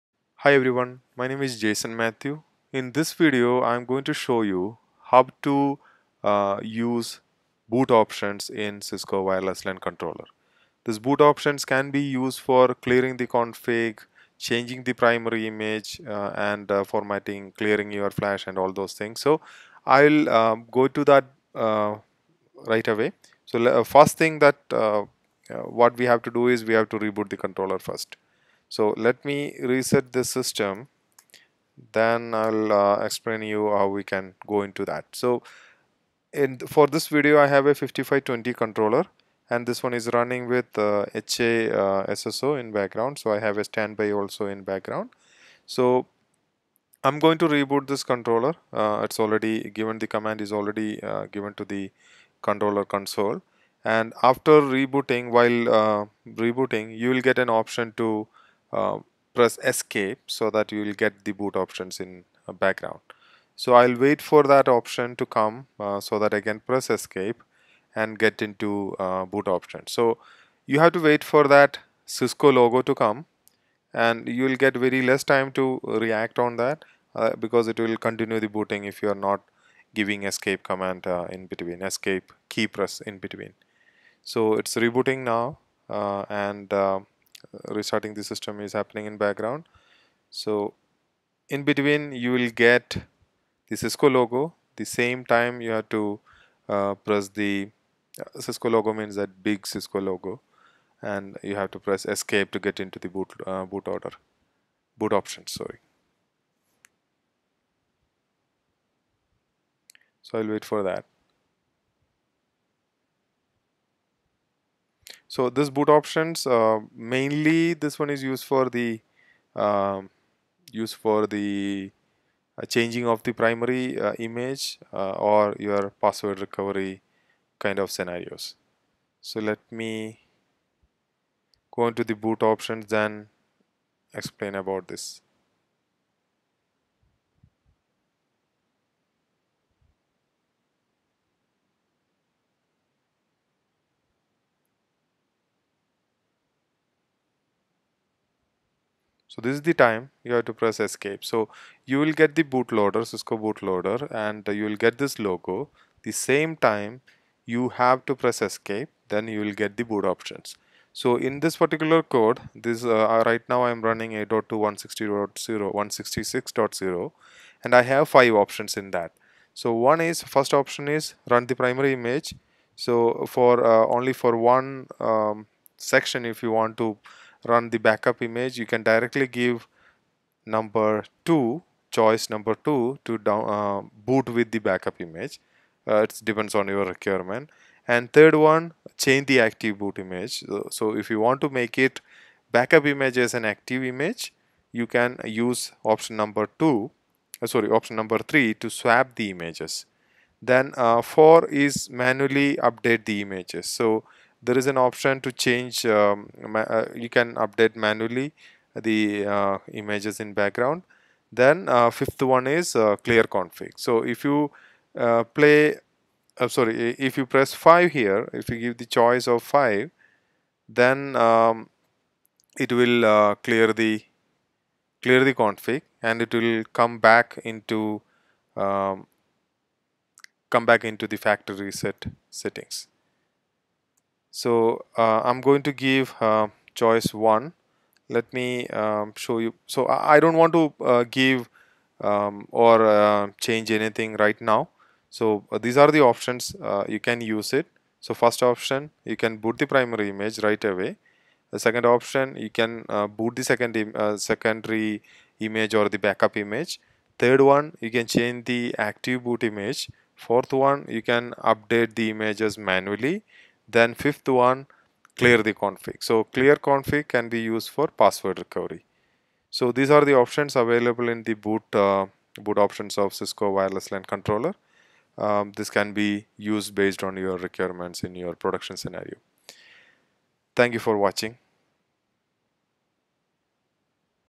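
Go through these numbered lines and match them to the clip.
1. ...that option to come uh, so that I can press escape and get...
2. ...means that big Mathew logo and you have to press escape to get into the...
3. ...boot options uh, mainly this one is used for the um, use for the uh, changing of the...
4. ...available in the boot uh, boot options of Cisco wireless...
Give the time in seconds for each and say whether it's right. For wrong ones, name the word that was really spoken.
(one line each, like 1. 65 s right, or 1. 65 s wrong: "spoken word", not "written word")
1. 64 s right
2. 98 s wrong: "Cisco", not "Mathew"
3. 115 s right
4. 270 s right.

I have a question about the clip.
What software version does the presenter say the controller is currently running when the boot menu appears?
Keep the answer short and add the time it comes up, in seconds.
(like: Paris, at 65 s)
8.2.166.0, at 165 s.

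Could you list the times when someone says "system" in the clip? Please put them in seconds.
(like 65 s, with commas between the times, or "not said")
30 s, 88 s.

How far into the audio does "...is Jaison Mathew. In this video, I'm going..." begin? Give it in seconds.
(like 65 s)
1 s.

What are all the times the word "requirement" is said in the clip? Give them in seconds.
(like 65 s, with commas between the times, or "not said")
186 s, 277 s.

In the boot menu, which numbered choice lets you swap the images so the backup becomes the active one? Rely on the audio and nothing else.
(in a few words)
3.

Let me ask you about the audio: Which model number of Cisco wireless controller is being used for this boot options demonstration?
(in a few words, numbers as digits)
5520.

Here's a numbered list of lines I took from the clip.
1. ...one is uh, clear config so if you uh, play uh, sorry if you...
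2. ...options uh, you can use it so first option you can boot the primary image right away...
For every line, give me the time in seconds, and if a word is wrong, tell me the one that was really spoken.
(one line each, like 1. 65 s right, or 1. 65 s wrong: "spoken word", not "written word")
1. 212 s right
2. 246 s right.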